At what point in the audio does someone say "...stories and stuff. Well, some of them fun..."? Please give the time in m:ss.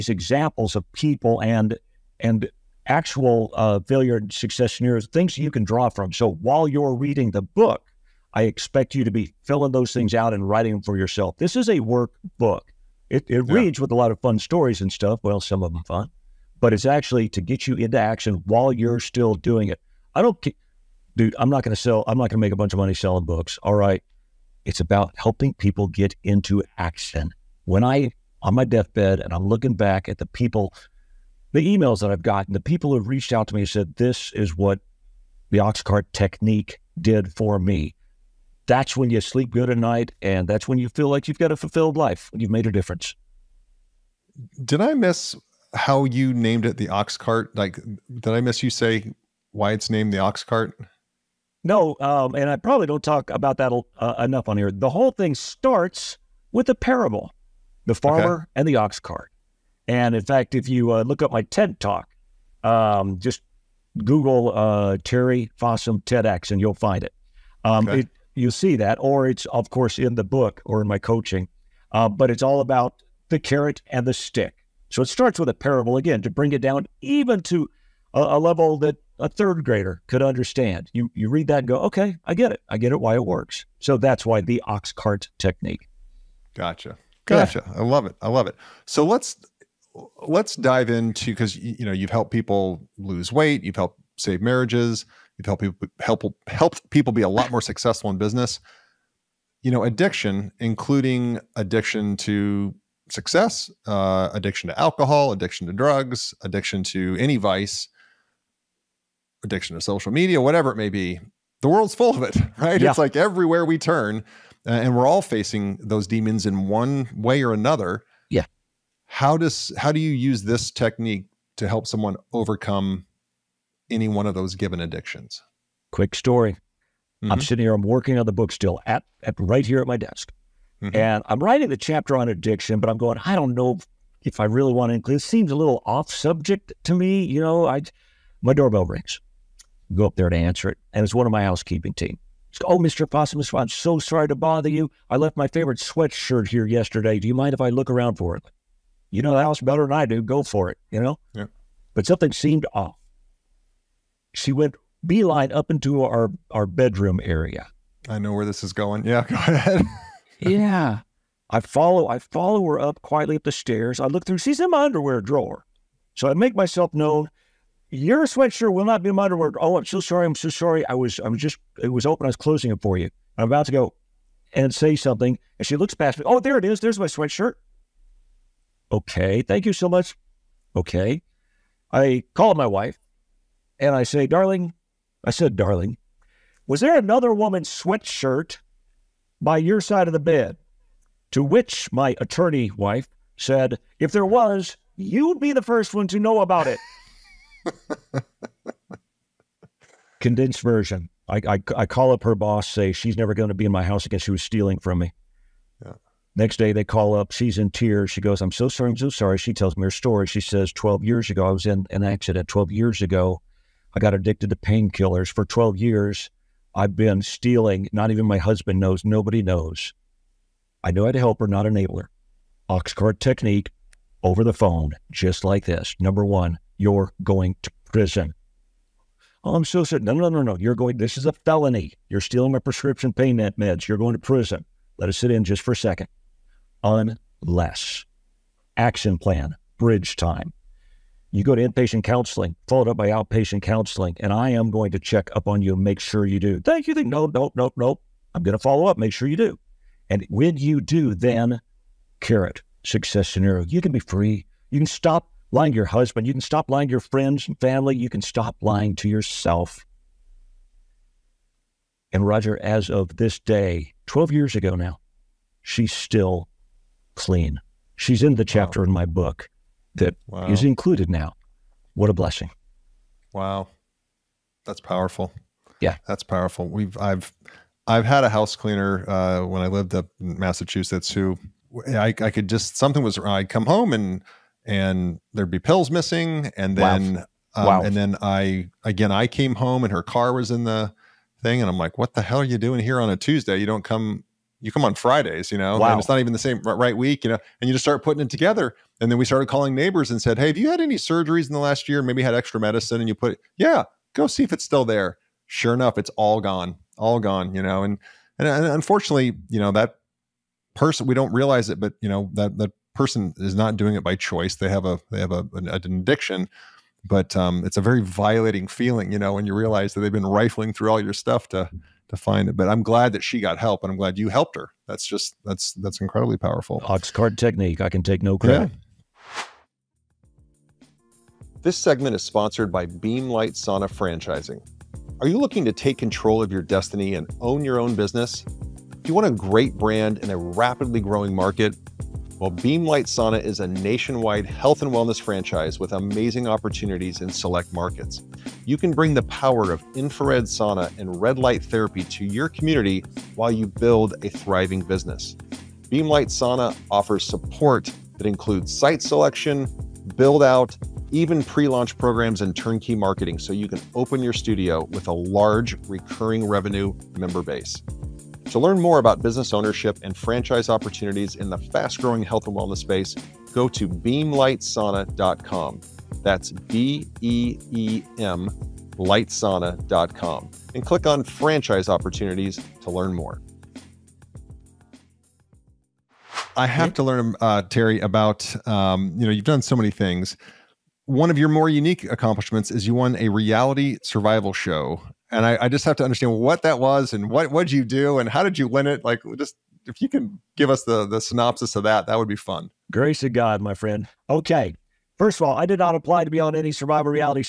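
0:14.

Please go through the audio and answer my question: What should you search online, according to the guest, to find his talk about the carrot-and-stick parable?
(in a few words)
Terry Fossum TEDx.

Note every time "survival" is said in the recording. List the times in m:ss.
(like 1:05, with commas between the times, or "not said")
6:34, 6:46.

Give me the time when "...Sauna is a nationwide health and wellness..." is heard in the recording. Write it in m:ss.
5:43.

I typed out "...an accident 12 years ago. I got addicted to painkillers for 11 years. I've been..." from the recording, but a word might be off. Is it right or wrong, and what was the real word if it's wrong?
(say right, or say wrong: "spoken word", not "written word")
wrong: "12", not "11".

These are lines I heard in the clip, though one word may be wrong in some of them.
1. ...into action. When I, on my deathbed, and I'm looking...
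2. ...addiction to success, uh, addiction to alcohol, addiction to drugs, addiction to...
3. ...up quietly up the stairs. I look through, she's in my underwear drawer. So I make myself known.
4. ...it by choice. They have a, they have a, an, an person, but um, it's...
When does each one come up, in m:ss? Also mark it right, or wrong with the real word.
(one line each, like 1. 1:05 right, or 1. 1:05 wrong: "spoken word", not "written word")
1. 0:26 right
2. 1:41 right
3. 2:42 right
4. 5:13 wrong: "addiction", not "person".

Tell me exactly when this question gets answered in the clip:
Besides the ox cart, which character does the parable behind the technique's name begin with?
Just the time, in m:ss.
0:57.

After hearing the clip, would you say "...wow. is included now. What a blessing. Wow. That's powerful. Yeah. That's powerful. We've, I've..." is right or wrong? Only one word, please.
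right.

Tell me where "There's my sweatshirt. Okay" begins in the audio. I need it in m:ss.
2:56.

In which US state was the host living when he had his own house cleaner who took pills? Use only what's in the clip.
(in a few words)
Massachusetts.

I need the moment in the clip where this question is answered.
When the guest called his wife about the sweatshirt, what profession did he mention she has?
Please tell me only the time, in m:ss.
3:12.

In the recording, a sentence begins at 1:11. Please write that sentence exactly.
Uh, but it's all about the carrot and the stick.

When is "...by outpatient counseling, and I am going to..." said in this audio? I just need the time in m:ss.
4:02.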